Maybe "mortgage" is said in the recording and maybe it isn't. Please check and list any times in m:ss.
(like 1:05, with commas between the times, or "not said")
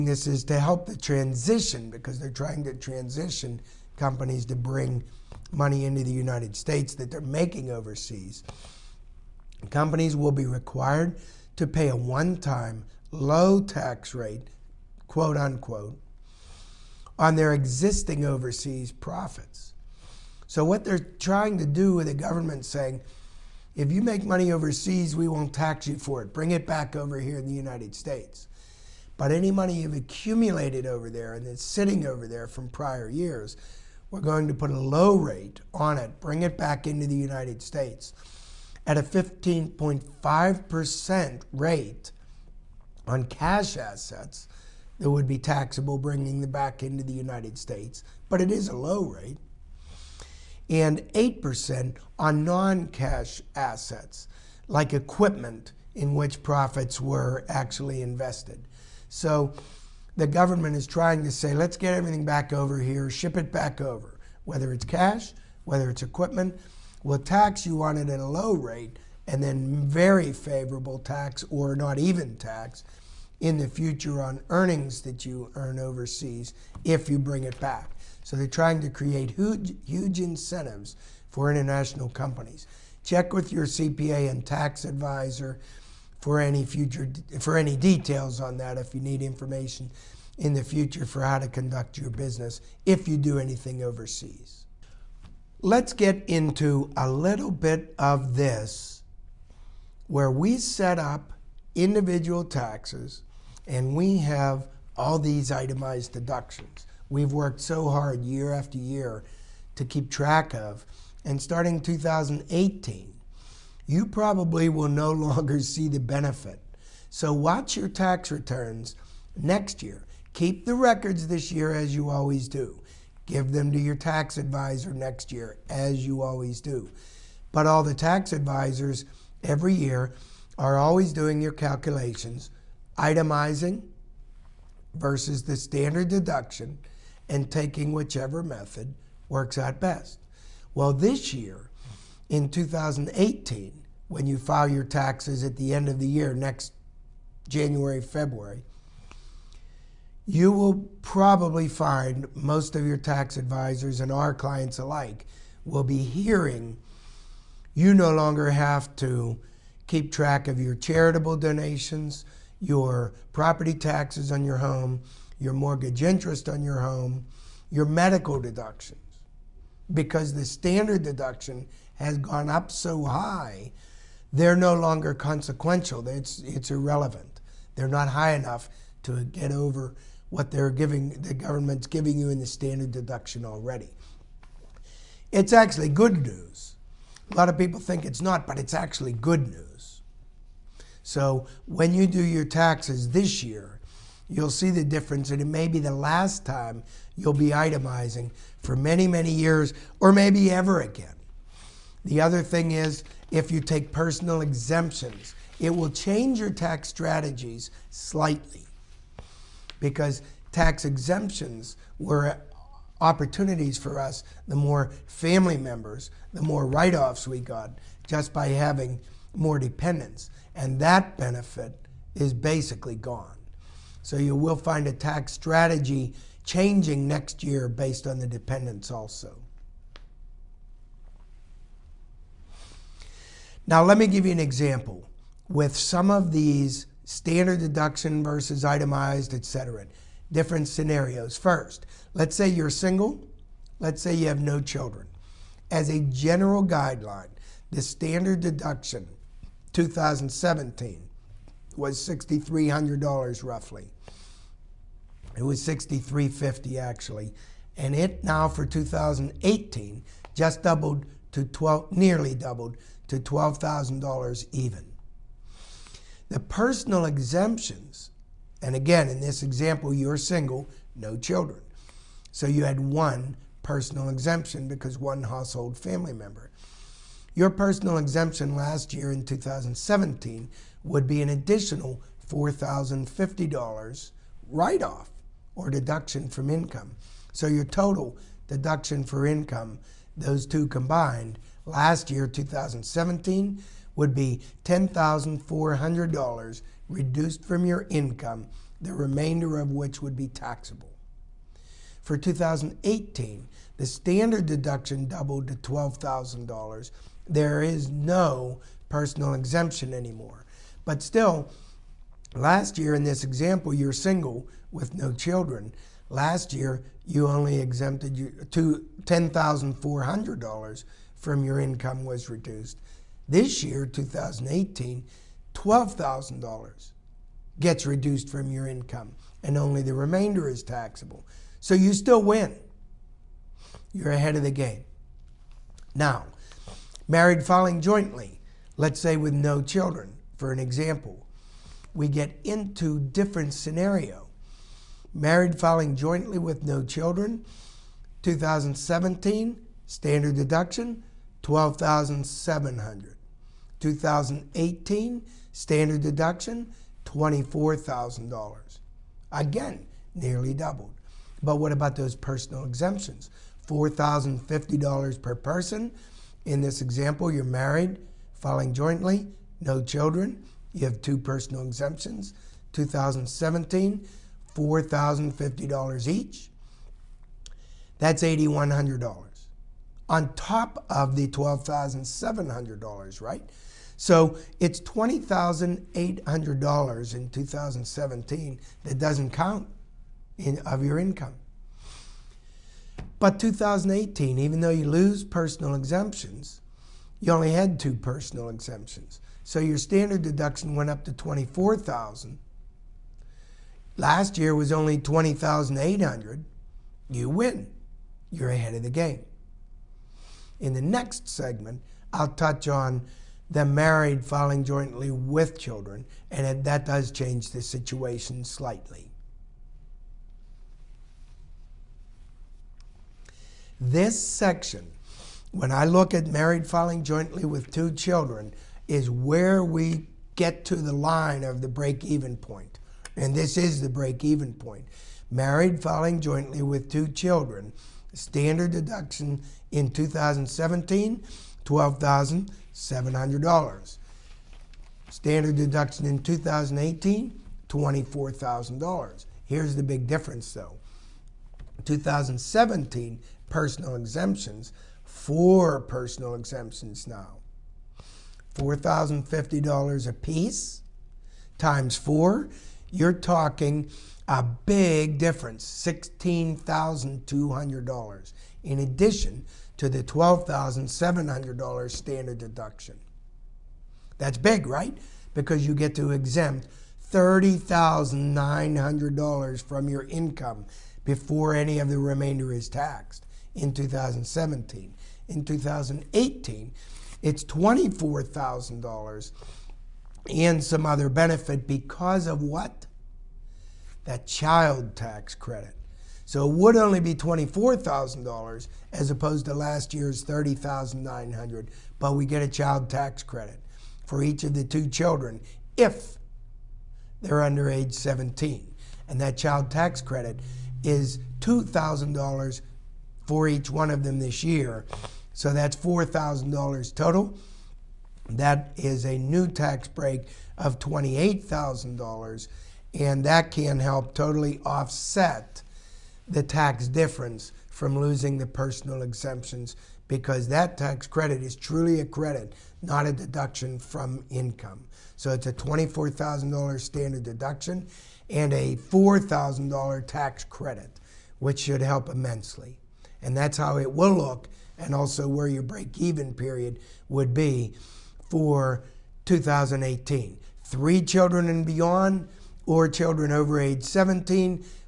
2:45.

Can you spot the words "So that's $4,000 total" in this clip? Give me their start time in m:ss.
8:35.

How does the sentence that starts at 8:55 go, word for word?
So it's a $24,000 standard deduction and a $4,000 tax credit, which should help immensely.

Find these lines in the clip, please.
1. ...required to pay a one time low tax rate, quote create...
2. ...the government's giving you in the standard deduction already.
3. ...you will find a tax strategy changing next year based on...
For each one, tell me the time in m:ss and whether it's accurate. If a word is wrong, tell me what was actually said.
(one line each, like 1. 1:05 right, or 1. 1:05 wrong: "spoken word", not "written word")
1. 0:10 wrong: "unquote", not "create"
2. 3:01 right
3. 3:44 right.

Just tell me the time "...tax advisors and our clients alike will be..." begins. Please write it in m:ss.
2:32.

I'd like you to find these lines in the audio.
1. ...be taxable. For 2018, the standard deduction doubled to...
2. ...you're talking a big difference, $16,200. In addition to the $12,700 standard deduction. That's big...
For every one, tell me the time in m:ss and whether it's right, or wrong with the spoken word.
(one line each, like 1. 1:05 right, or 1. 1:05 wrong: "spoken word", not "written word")
1. 5:00 right
2. 7:42 right.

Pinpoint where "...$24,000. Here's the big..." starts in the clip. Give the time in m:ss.
7:27.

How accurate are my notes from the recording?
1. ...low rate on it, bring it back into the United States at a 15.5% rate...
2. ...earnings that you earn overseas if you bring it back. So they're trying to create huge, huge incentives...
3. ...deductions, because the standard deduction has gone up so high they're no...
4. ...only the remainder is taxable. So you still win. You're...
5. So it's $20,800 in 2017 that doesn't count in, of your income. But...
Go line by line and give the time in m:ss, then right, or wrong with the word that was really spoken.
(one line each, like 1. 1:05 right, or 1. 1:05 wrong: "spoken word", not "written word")
1. 0:34 right
2. 1:14 right
3. 2:48 right
4. 5:29 right
5. 6:23 right.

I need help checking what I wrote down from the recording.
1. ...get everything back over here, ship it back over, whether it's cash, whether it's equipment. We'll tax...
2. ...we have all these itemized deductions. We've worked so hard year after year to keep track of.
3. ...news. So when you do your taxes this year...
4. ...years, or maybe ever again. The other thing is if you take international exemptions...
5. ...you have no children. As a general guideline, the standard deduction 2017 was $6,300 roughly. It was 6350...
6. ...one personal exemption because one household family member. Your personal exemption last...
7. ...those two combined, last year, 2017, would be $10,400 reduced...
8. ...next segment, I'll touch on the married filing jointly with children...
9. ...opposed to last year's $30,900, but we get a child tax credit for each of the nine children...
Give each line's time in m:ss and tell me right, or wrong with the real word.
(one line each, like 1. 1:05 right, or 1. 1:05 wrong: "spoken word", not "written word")
1. 1:01 right
2. 1:43 right
3. 3:09 right
4. 3:19 wrong: "personal", not "international"
5. 4:04 right
6. 4:32 right
7. 4:50 right
8. 6:50 right
9. 8:19 wrong: "two", not "nine".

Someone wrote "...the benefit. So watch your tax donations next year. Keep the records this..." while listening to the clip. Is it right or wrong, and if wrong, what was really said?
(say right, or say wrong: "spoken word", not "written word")
wrong: "returns", not "donations".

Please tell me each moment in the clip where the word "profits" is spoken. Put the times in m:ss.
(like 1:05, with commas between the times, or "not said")
0:18, 0:56.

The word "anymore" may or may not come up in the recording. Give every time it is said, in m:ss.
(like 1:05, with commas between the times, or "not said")
5:09.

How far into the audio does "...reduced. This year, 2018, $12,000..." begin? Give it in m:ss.
5:22.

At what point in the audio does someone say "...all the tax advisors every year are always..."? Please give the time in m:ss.
2:07.